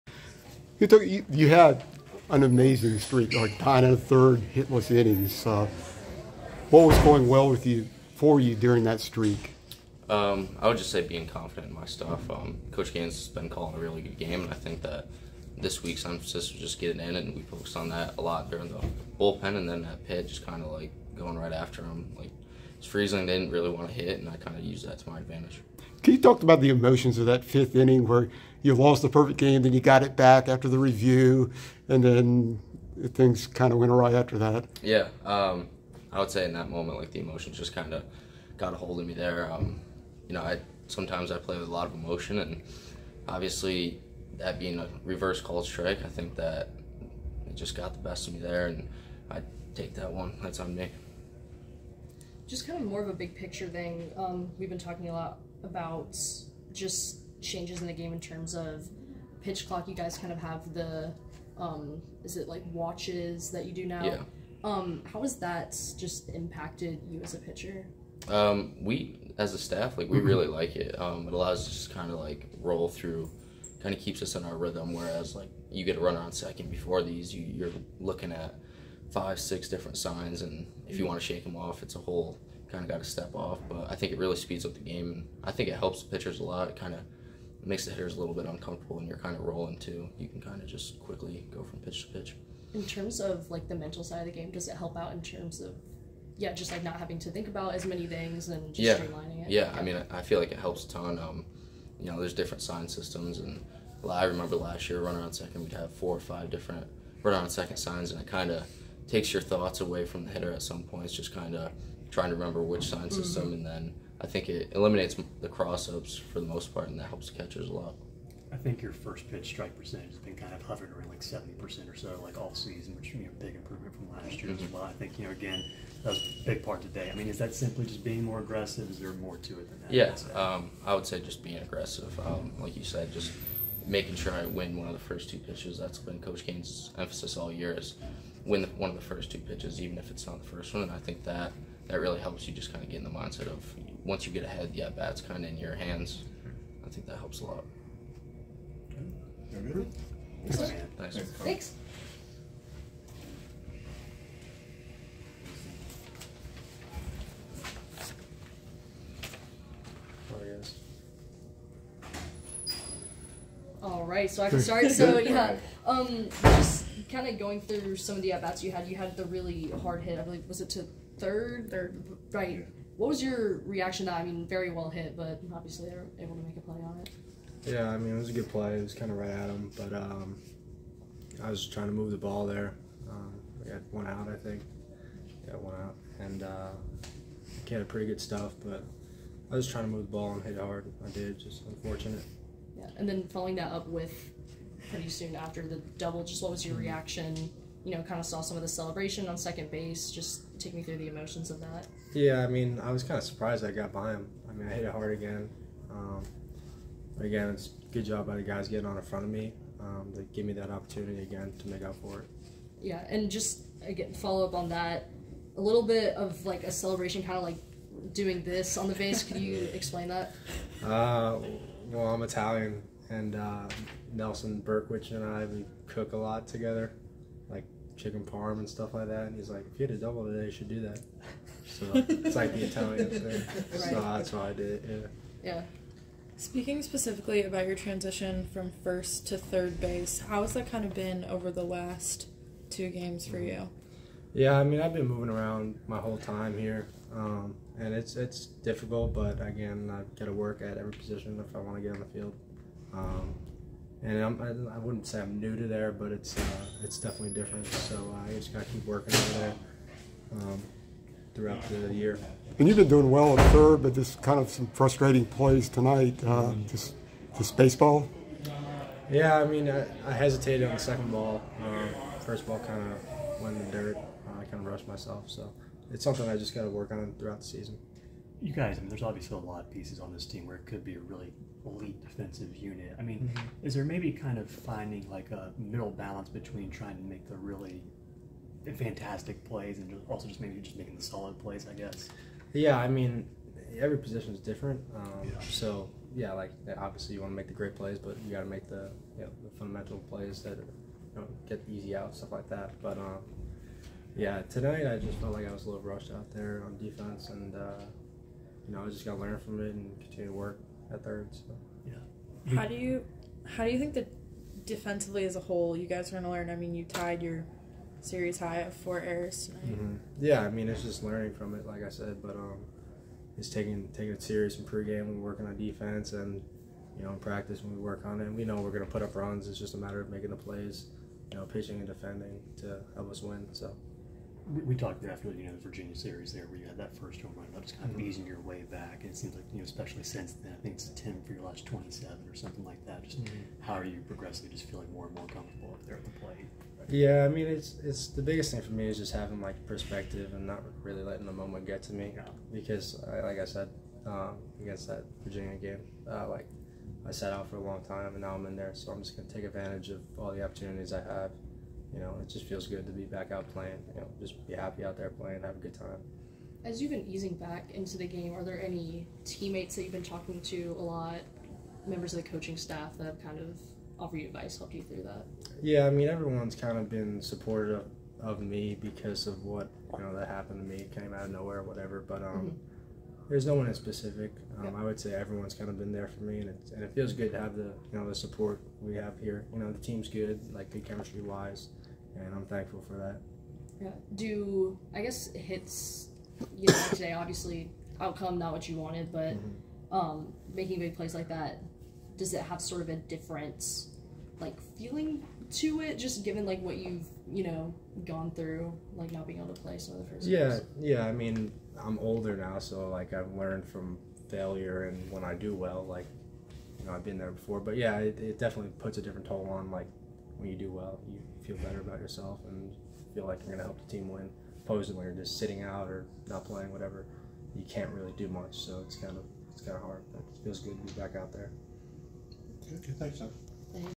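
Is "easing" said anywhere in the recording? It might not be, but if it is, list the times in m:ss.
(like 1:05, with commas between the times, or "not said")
5:38, 6:07.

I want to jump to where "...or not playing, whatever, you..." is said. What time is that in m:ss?
7:05.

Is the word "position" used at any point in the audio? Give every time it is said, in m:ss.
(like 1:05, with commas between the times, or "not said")
4:10, 4:53.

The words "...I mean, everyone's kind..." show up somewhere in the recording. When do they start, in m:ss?
6:15.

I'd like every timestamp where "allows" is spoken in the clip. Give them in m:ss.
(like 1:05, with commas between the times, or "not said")
1:11.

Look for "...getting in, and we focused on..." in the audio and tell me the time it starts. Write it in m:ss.
0:16.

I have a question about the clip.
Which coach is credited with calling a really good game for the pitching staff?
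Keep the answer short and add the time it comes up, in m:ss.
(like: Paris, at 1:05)
Coach Gaines, at 0:12.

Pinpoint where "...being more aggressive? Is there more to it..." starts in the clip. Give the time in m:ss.
2:08.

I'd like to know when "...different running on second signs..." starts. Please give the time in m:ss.
1:46.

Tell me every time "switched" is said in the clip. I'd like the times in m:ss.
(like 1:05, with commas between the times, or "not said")
not said.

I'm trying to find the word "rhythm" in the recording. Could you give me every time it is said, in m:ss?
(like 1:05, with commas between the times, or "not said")
1:14.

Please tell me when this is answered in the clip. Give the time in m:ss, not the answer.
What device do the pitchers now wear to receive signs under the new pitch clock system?
1:02.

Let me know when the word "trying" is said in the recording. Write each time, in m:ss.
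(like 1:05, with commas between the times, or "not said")
1:52, 3:01, 3:09, 4:46.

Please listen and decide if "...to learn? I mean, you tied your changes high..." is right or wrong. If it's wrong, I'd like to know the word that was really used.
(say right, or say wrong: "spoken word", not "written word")
wrong: "series", not "changes".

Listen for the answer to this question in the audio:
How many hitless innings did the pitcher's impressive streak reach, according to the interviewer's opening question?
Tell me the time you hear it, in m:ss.
0:03.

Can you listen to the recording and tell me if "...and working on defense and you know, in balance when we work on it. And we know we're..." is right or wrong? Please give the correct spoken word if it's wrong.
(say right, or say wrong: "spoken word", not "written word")
wrong: "practice", not "balance".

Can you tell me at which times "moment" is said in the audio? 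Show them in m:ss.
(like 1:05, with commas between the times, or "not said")
0:36, 5:51.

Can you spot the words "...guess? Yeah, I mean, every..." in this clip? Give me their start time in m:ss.
4:51.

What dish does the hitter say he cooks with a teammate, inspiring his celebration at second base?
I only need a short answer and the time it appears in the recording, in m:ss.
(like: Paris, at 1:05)
Chicken parm, at 3:47.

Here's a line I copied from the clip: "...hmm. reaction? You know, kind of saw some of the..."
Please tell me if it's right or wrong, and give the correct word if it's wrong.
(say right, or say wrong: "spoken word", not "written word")
right.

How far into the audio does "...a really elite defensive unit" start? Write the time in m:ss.
4:40.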